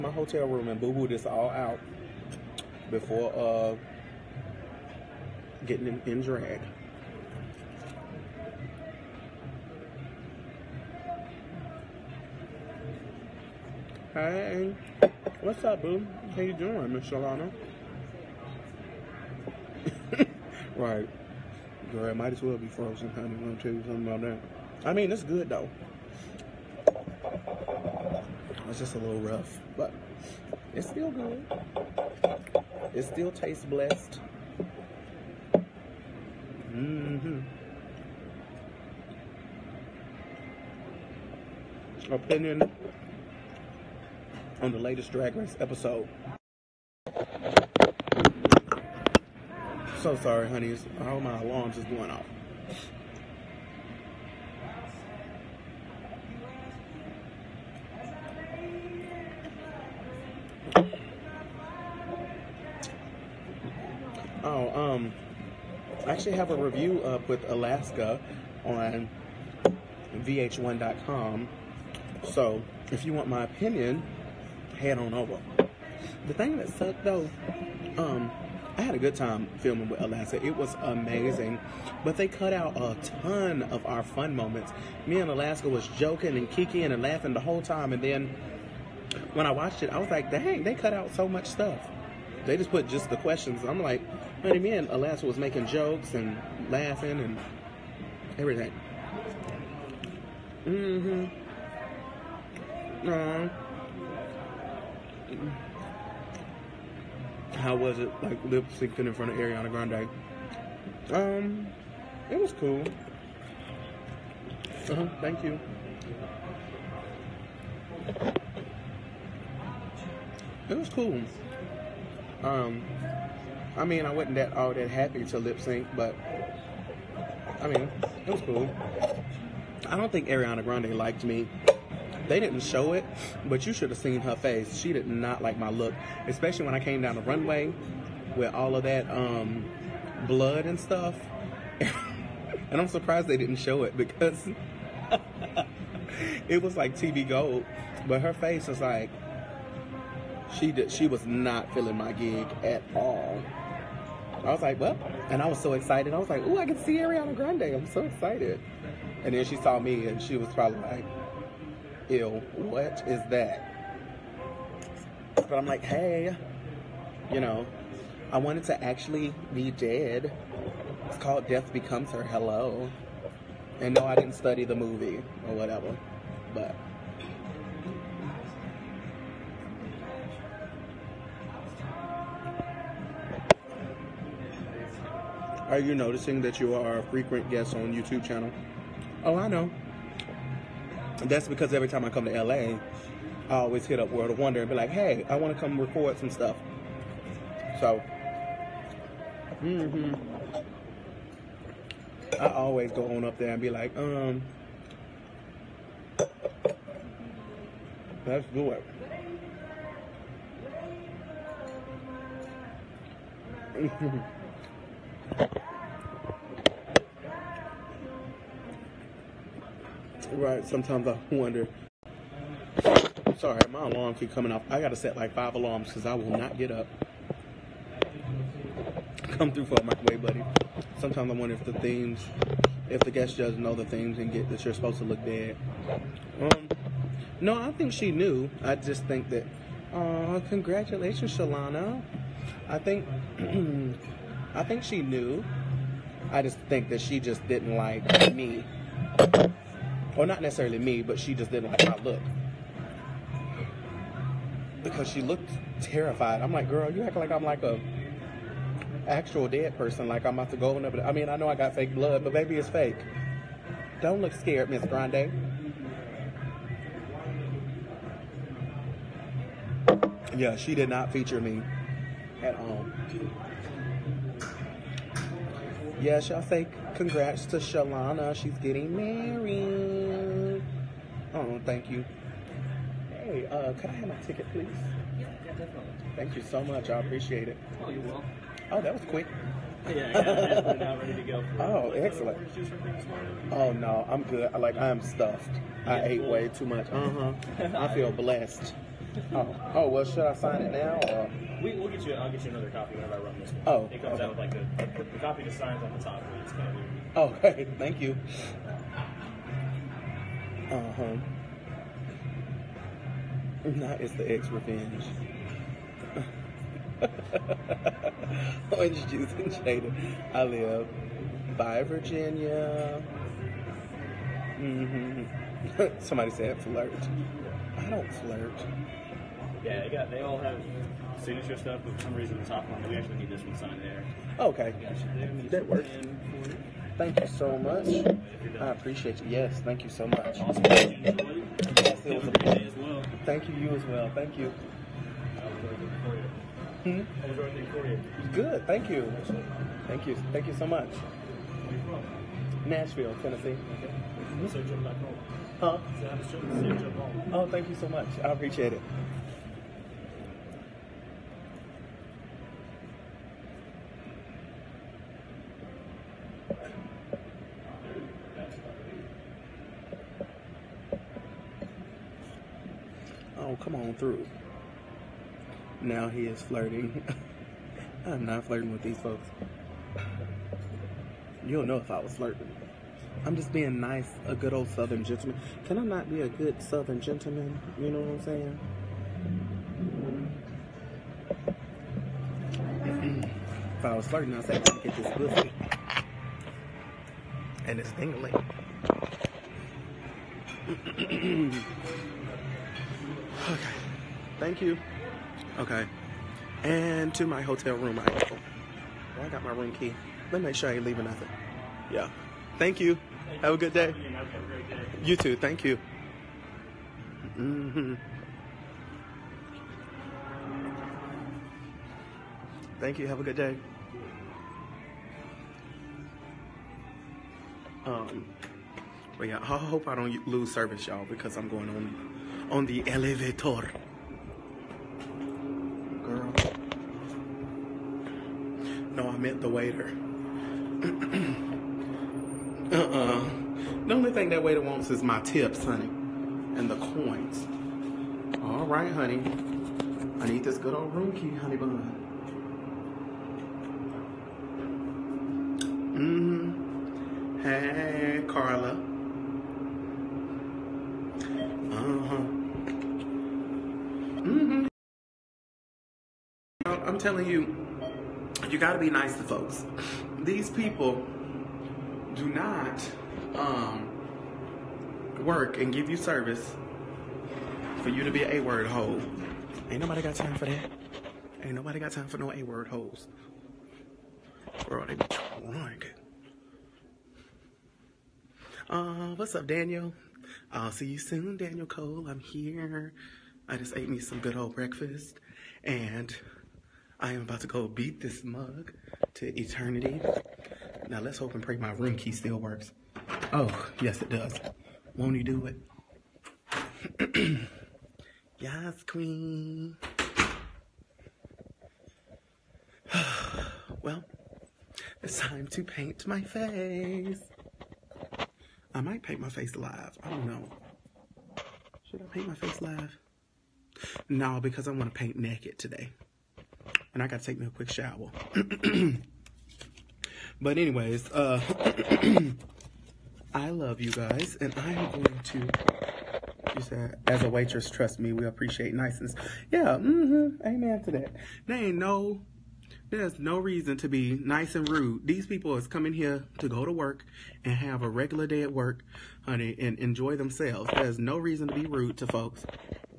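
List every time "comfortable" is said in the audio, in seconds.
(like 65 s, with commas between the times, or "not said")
not said.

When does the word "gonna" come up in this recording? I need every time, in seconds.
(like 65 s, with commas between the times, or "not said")
23 s, 394 s.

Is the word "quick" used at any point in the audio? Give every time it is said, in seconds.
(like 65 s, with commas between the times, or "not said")
289 s, 527 s.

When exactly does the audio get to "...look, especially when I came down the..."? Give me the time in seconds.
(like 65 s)
135 s.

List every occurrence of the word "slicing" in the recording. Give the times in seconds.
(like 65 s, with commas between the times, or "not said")
not said.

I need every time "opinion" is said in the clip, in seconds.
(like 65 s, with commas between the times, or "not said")
42 s, 73 s.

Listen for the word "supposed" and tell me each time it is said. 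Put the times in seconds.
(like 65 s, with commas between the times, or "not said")
234 s.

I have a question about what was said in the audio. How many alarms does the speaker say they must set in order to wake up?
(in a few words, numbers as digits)
5.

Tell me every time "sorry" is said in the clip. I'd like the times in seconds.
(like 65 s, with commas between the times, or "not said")
50 s, 223 s.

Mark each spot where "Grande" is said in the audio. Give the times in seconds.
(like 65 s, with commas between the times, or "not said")
109 s, 130 s, 157 s, 264 s.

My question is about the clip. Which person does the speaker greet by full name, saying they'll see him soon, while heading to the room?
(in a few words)
Daniel Cole.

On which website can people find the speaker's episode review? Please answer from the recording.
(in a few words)
VH1.com.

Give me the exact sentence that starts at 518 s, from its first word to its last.
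I might paint my face live.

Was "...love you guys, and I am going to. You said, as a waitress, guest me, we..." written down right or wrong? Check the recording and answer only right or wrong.
wrong.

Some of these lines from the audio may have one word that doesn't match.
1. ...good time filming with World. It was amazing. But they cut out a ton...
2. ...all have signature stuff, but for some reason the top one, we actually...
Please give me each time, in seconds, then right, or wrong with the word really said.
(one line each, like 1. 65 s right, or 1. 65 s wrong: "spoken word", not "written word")
1. 78 s wrong: "Alaska", not "World"
2. 330 s right.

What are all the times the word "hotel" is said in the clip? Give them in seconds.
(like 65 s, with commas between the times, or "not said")
0 s, 407 s.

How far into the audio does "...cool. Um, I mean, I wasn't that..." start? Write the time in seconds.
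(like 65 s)
120 s.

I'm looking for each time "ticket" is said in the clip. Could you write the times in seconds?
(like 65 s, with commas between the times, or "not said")
284 s.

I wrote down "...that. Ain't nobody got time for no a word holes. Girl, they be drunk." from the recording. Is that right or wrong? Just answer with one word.
right.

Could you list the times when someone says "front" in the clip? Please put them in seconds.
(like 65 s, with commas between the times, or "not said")
109 s.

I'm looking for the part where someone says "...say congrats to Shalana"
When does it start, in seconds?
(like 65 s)
276 s.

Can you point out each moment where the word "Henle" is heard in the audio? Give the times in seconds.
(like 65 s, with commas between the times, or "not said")
not said.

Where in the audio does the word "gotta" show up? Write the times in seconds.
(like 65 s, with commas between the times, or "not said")
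224 s, 527 s.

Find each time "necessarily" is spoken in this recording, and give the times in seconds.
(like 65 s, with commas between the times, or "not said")
250 s.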